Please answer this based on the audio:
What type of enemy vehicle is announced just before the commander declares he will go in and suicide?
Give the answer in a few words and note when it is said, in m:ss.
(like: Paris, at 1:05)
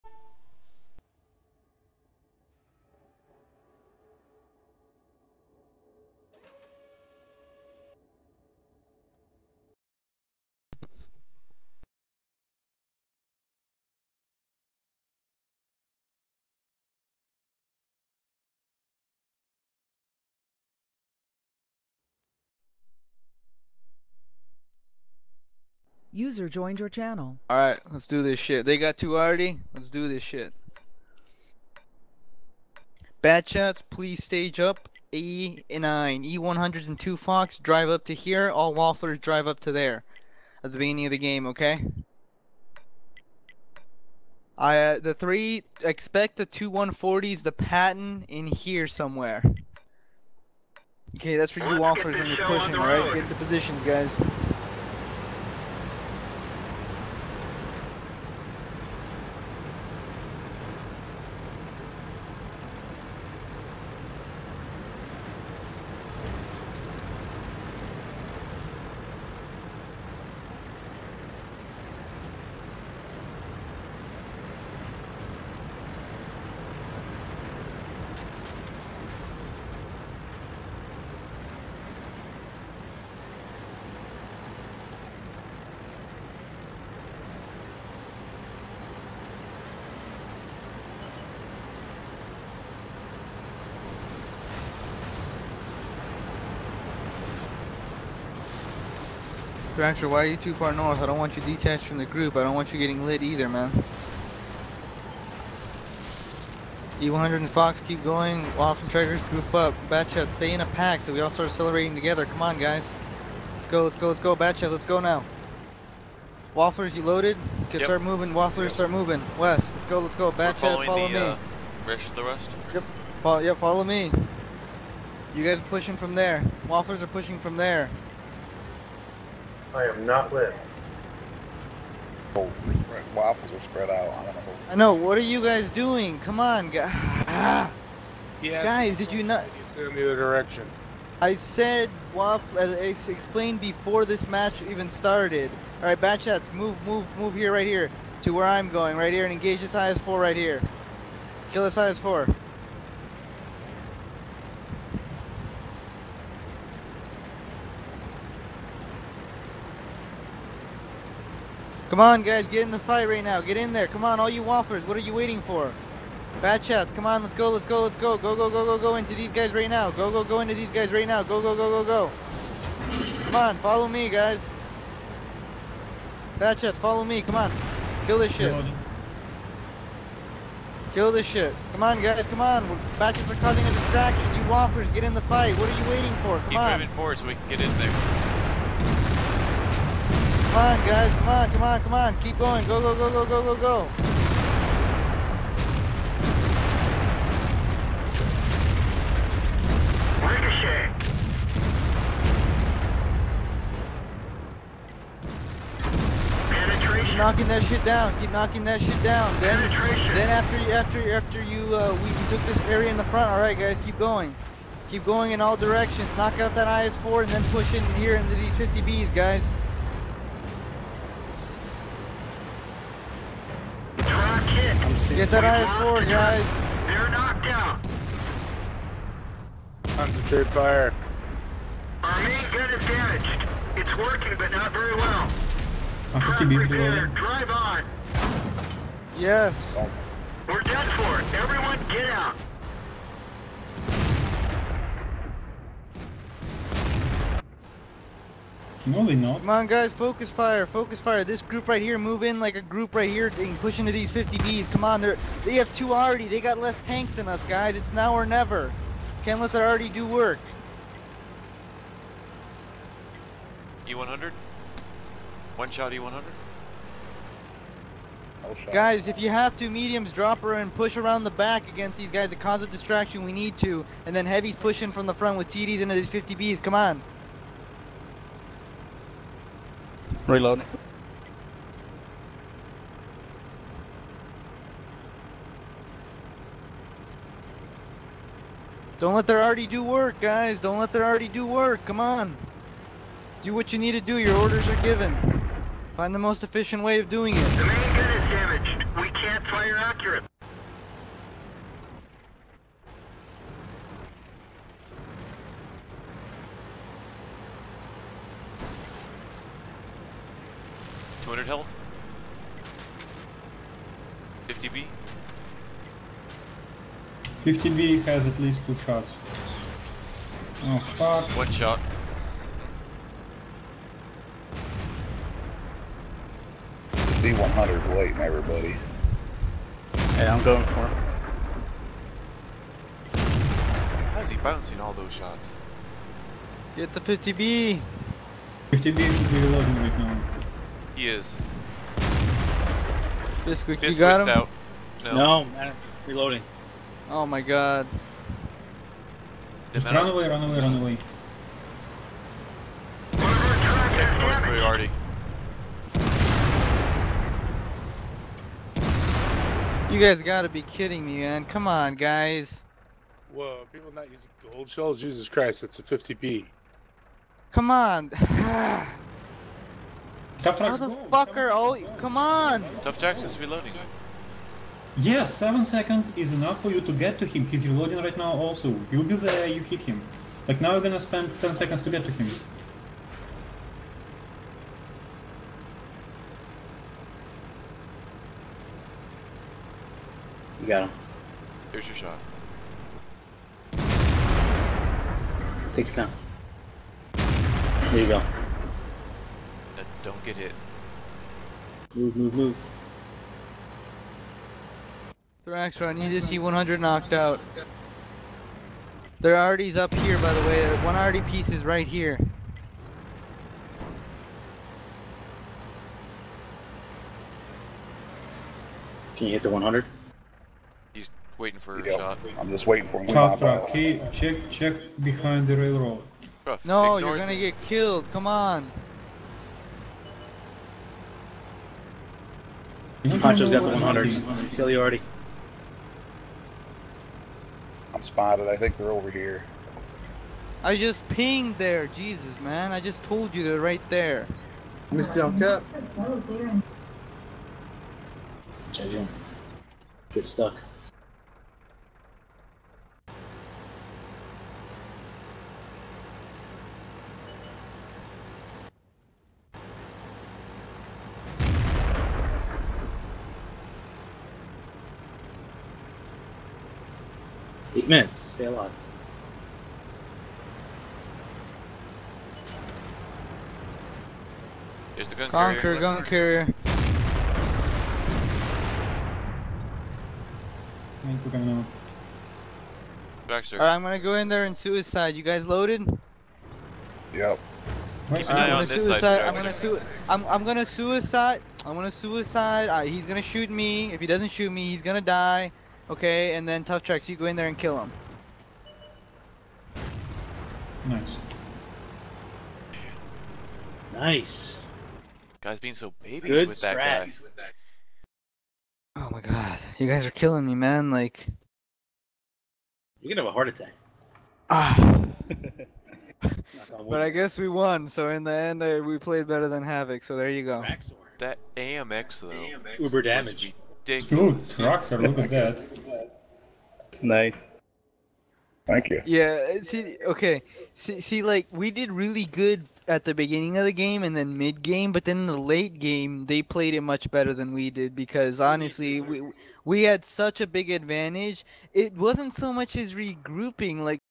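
gun carrier, at 7:55.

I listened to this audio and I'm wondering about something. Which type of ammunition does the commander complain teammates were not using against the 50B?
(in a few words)
gold shells.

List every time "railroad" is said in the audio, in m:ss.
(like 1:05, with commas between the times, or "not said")
7:05.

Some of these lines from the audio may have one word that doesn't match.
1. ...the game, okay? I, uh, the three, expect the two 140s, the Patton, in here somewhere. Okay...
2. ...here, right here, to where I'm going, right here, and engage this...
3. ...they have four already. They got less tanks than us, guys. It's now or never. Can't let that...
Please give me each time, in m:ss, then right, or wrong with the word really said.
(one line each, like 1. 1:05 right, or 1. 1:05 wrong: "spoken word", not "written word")
1. 0:41 right
2. 2:27 right
3. 4:15 wrong: "two", not "four".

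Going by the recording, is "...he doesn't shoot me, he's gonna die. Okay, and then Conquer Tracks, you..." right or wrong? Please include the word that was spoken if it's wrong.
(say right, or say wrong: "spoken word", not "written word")
wrong: "Tough", not "Conquer".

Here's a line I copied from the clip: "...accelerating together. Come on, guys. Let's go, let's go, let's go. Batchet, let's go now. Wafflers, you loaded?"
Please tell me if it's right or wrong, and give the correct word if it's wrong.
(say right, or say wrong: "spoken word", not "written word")
right.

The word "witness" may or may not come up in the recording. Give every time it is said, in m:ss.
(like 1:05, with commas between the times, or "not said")
not said.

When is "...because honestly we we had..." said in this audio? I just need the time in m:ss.
8:57.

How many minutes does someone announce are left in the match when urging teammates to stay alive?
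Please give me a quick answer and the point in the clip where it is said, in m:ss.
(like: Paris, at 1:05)
8, at 7:47.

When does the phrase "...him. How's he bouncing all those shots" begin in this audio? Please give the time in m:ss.
5:30.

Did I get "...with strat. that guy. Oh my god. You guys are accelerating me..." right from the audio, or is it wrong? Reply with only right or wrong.
wrong.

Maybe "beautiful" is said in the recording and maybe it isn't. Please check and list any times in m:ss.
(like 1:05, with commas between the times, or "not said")
not said.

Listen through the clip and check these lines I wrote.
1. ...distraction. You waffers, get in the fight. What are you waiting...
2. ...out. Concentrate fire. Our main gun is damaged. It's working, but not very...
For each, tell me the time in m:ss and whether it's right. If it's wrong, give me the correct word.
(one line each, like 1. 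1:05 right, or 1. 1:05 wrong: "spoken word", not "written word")
1. 3:03 right
2. 3:47 right.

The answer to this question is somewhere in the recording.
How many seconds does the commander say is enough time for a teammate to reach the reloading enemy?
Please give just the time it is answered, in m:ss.
6:15.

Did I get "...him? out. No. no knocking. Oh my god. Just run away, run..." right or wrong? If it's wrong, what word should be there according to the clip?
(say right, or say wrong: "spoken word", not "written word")
wrong: "reloading", not "knocking".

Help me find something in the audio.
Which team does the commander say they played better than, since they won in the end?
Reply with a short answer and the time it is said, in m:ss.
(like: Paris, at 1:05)
Havoc, at 8:39.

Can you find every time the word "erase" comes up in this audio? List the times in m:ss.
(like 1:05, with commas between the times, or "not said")
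not said.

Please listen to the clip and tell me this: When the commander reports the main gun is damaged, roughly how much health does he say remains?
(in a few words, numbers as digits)
200.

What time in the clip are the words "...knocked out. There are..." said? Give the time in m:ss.
6:46.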